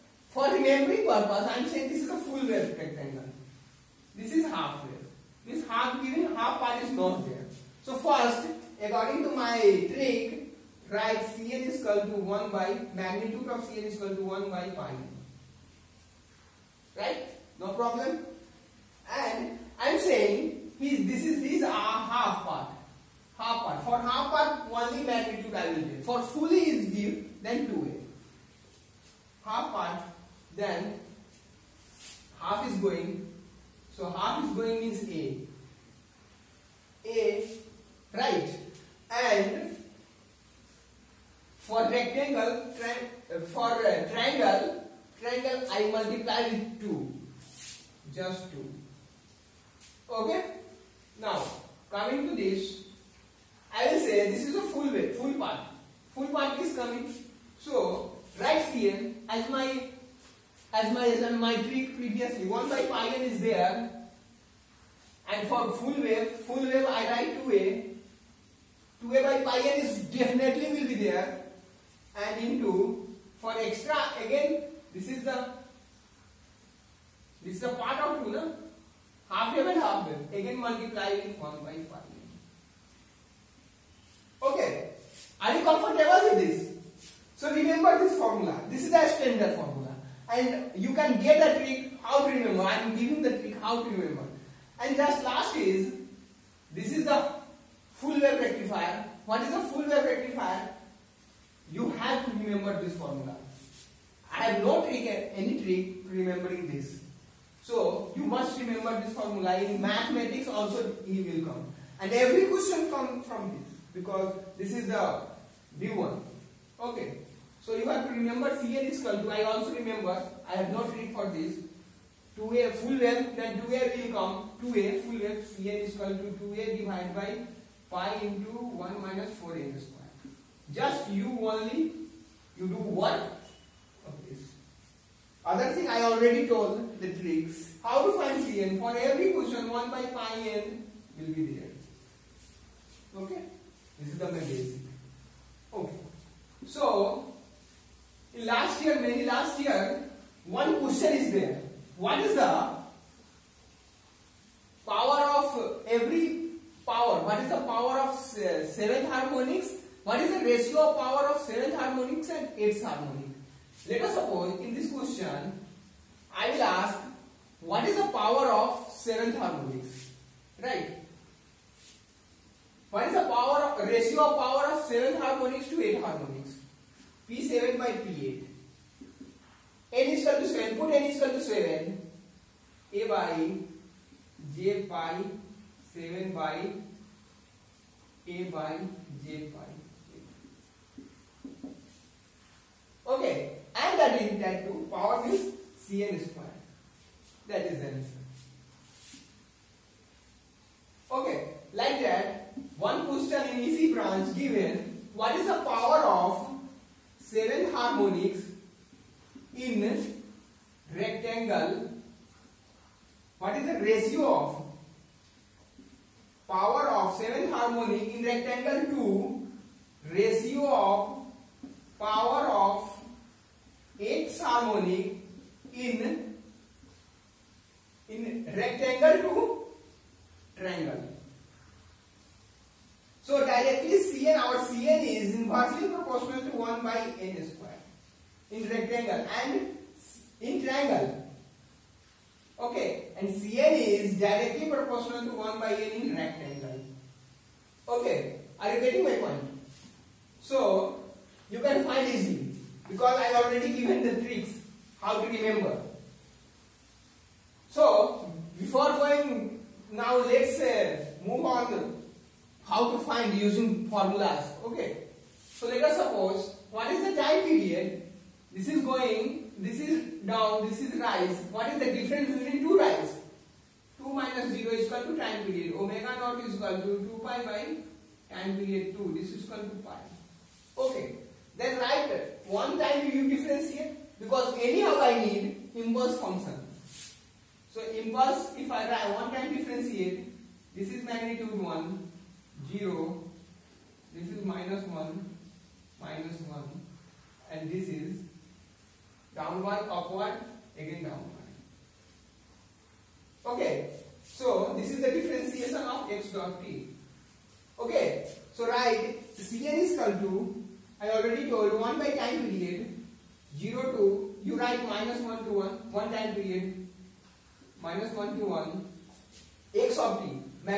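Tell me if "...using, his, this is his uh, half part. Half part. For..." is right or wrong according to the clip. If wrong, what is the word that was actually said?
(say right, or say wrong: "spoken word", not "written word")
wrong: "saying", not "using".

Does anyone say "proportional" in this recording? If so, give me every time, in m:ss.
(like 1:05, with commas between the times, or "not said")
3:55, 4:04.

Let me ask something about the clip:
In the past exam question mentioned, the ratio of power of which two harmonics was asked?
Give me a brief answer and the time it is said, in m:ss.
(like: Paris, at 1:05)
7th and 8th, at 2:41.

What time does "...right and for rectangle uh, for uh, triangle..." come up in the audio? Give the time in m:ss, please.
0:38.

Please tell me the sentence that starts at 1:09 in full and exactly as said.
2a by pi n is definitely will be there.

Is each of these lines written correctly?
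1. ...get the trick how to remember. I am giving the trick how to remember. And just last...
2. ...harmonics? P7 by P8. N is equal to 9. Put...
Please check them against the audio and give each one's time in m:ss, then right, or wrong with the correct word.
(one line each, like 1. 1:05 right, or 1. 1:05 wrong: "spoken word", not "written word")
1. 1:31 right
2. 2:56 wrong: "7", not "9".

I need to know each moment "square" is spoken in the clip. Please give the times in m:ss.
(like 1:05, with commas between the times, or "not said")
2:09, 3:16, 3:57.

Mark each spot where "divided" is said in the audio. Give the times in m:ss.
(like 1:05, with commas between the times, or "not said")
2:06.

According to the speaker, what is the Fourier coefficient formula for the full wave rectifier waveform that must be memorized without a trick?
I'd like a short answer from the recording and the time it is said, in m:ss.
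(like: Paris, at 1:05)
2a / (pi(1 - 4n^2)), at 2:06.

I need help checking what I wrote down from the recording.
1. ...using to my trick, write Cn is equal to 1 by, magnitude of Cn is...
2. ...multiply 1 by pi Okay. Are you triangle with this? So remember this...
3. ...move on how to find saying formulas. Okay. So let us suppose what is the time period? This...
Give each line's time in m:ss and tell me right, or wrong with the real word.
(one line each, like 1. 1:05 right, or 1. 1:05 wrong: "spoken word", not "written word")
1. 0:08 wrong: "according", not "using"
2. 1:20 wrong: "comfortable", not "triangle"
3. 4:21 wrong: "using", not "saying".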